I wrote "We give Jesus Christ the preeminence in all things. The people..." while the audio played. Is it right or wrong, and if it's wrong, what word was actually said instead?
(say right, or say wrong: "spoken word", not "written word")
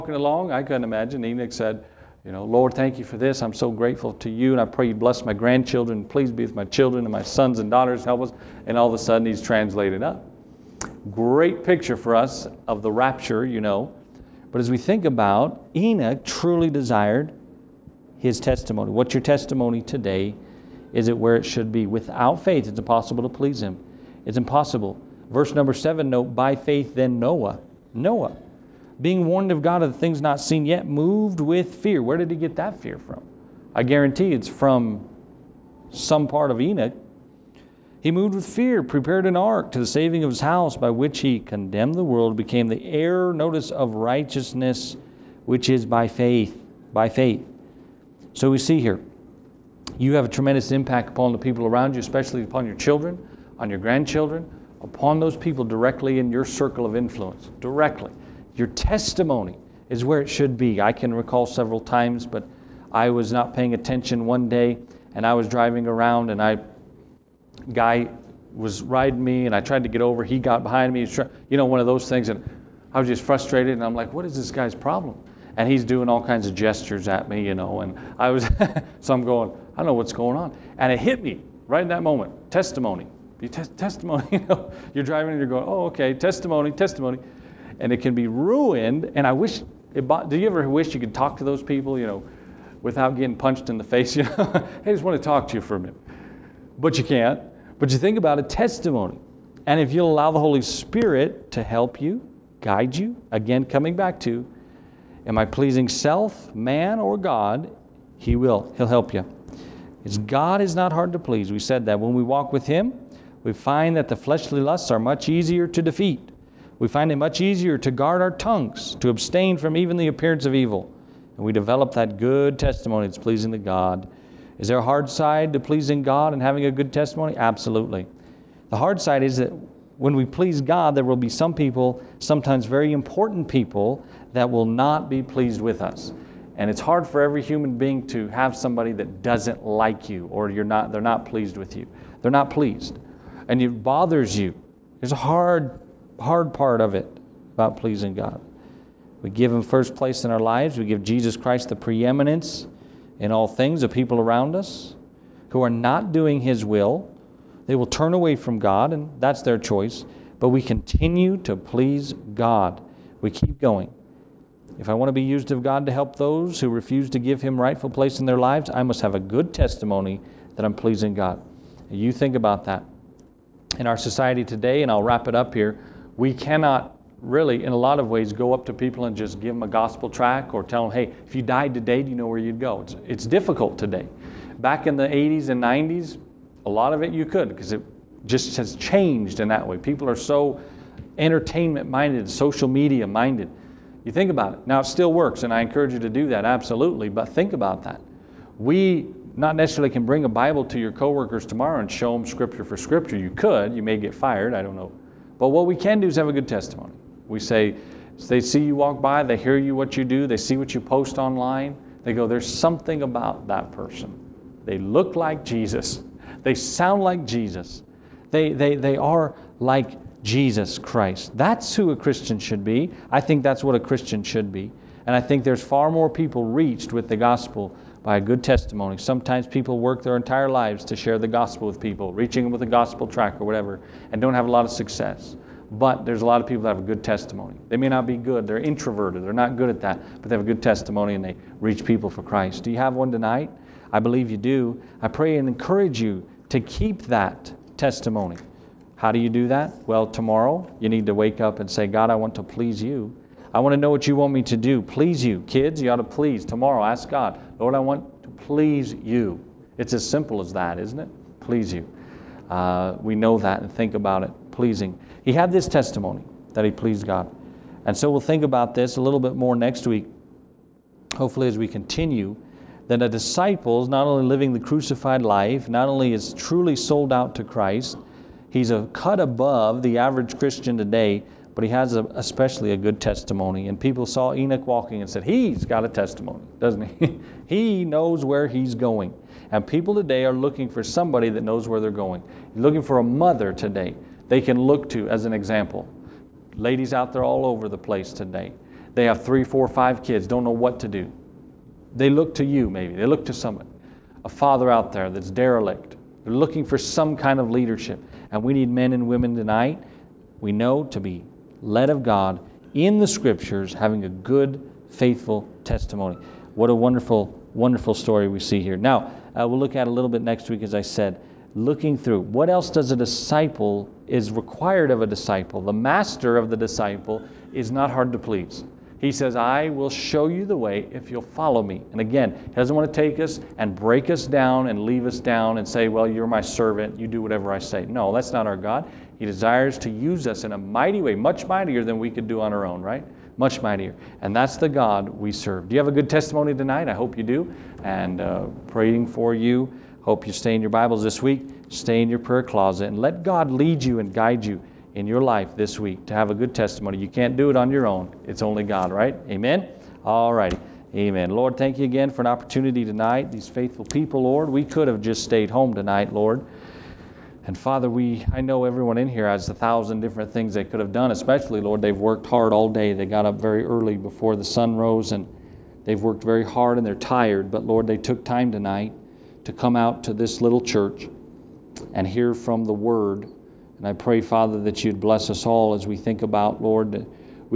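right.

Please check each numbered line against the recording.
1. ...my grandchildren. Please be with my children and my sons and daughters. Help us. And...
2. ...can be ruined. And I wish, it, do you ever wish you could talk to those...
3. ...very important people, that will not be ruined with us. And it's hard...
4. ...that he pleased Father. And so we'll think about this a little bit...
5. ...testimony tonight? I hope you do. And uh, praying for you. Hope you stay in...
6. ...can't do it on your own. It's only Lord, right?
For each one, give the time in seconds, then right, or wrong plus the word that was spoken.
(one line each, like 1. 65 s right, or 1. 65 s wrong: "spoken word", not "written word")
1. 5 s right
2. 87 s right
3. 132 s wrong: "pleased", not "ruined"
4. 266 s wrong: "God", not "Father"
5. 346 s right
6. 357 s wrong: "God", not "Lord".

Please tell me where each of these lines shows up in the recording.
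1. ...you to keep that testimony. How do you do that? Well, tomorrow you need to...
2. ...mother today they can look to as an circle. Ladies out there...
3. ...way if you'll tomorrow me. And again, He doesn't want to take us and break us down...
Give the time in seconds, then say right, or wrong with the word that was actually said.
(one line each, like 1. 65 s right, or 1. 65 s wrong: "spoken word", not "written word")
1. 246 s right
2. 293 s wrong: "example", not "circle"
3. 330 s wrong: "follow", not "tomorrow".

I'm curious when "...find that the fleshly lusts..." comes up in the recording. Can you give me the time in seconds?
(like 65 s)
113 s.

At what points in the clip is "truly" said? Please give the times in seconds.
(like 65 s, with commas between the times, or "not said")
16 s, 276 s.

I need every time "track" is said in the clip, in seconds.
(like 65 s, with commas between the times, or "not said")
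180 s, 233 s.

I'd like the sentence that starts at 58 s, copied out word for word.
Your testimony is where it should be.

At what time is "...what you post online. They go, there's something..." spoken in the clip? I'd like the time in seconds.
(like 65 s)
210 s.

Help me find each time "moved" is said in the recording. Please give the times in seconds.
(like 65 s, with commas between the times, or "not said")
30 s, 38 s.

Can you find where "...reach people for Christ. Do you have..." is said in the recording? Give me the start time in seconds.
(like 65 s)
241 s.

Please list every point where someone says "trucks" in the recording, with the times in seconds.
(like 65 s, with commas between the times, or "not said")
not said.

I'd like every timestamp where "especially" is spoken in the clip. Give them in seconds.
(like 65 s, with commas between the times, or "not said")
51 s, 282 s, 371 s.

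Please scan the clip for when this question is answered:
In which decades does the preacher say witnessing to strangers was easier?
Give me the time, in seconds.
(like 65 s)
185 s.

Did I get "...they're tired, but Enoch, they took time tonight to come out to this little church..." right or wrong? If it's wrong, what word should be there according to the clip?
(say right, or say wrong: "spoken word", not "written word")
wrong: "Lord", not "Enoch".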